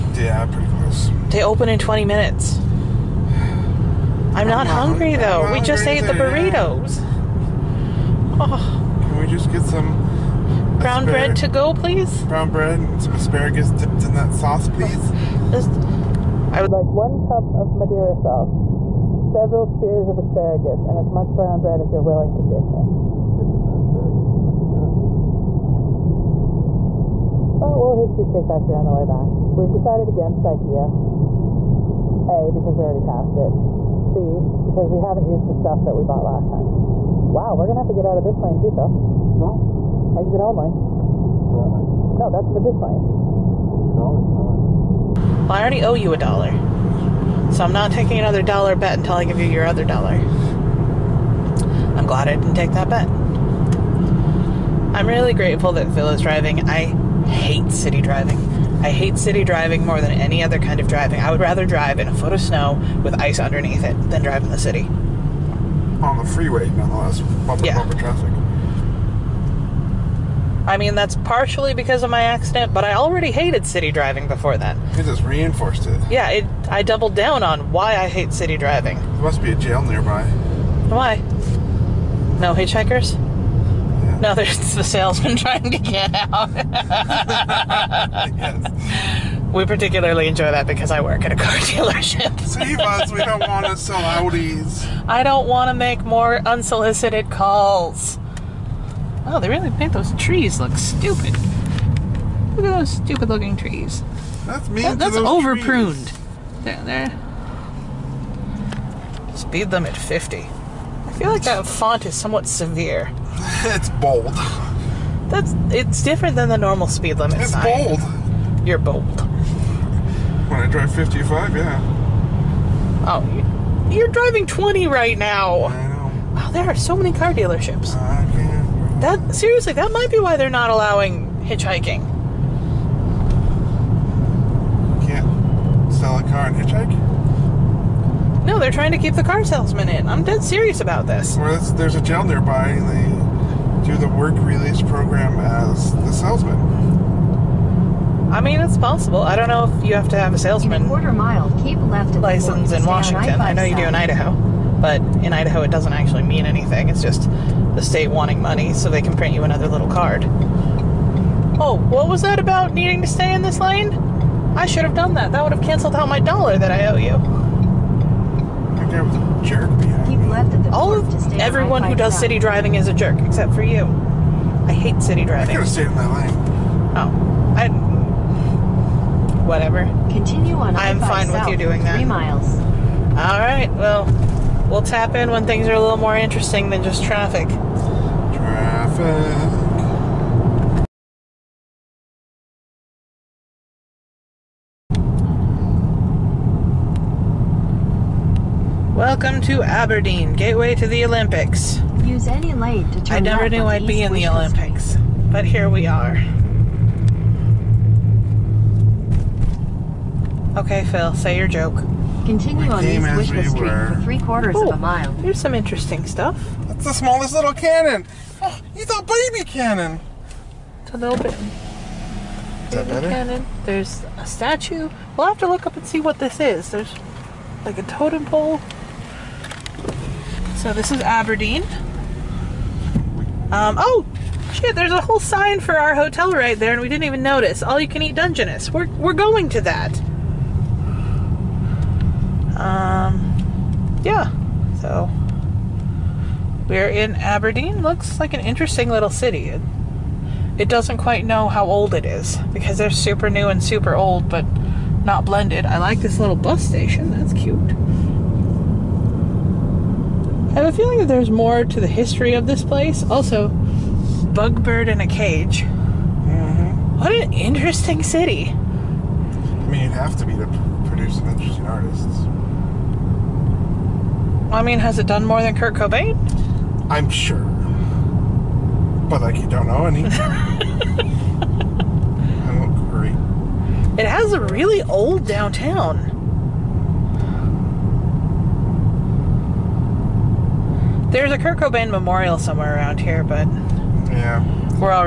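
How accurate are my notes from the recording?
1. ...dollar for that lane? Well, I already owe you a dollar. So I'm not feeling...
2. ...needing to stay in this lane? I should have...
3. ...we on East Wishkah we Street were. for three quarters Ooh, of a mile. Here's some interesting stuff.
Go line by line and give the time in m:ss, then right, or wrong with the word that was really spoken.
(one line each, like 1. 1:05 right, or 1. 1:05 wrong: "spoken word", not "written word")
1. 0:43 wrong: "taking", not "feeling"
2. 2:42 right
3. 3:32 right.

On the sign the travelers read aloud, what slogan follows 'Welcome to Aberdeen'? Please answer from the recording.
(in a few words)
gateway to the Olympics.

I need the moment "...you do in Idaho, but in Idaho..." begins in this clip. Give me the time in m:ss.
2:33.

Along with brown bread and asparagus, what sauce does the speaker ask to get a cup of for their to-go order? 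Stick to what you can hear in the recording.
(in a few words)
Madeira sauce.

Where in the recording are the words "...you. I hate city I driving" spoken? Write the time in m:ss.
2:53.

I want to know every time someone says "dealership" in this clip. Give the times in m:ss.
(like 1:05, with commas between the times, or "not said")
1:31, 2:07.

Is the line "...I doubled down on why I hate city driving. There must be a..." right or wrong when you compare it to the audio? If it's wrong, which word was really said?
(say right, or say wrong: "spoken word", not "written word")
right.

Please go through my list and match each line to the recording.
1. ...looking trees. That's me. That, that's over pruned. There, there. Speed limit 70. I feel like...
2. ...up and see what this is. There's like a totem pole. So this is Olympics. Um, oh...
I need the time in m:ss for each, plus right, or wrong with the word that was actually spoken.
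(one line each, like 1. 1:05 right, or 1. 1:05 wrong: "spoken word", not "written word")
1. 1:43 wrong: "50", not "70"
2. 3:45 wrong: "Aberdeen", not "Olympics".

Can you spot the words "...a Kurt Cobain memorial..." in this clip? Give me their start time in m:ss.
4:51.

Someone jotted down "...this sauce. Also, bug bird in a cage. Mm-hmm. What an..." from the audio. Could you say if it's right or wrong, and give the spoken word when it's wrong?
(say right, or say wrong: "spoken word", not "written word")
wrong: "place", not "sauce".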